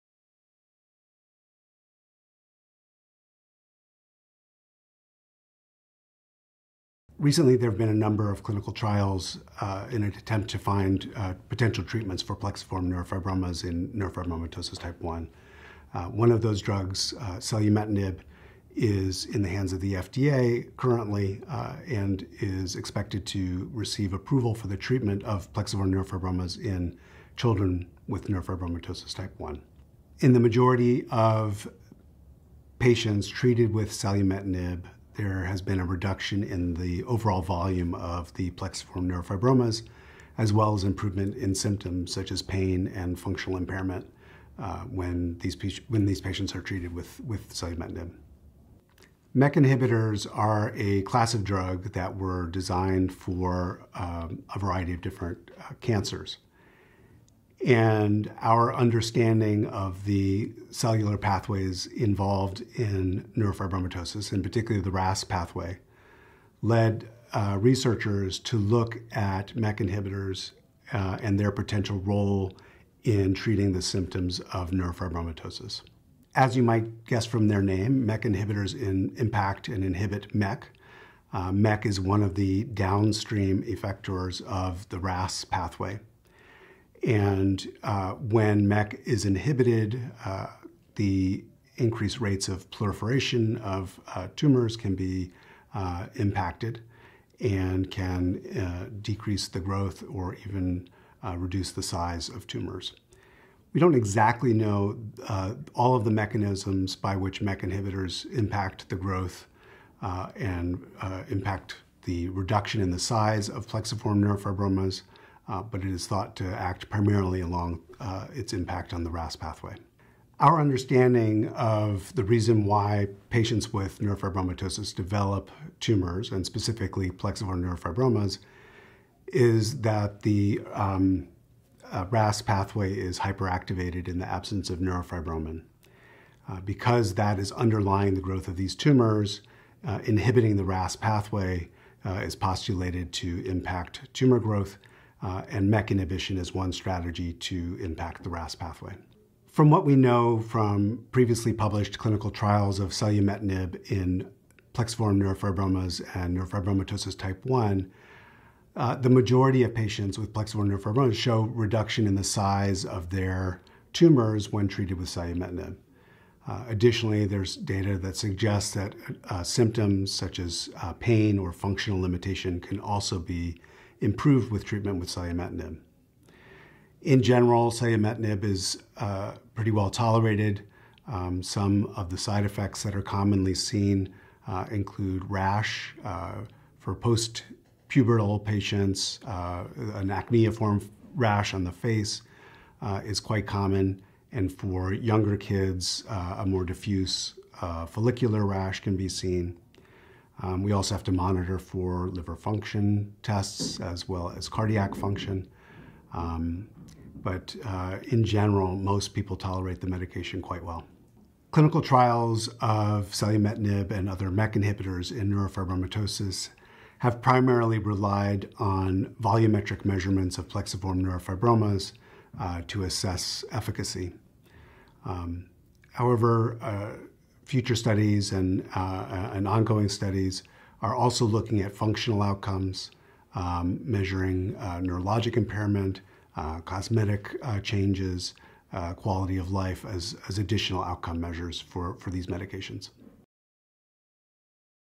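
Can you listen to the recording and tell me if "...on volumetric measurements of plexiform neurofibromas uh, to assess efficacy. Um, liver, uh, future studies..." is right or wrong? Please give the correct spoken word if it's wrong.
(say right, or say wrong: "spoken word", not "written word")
wrong: "however", not "liver".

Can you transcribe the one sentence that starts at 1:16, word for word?
As you might guess from their name, MEK inhibitors in impact and inhibit MEK.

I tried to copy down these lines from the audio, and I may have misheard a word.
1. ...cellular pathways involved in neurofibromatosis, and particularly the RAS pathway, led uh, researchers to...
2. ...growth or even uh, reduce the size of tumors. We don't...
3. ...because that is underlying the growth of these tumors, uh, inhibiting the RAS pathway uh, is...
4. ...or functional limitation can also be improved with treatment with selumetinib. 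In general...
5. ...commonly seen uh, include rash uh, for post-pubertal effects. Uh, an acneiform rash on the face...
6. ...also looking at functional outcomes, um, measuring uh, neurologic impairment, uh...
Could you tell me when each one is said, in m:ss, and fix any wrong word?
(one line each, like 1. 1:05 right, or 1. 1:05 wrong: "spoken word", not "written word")
1. 1:00 right
2. 1:39 right
3. 2:16 right
4. 2:51 right
5. 3:03 wrong: "patients", not "effects"
6. 3:50 right.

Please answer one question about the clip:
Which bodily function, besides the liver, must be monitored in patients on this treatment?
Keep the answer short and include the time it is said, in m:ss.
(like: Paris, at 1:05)
cardiac function, at 3:24.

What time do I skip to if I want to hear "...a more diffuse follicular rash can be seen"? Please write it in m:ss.
3:16.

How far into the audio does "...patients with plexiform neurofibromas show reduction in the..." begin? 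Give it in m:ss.
2:39.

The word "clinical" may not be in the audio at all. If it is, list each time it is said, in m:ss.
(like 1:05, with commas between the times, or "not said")
0:08, 2:31, 3:31.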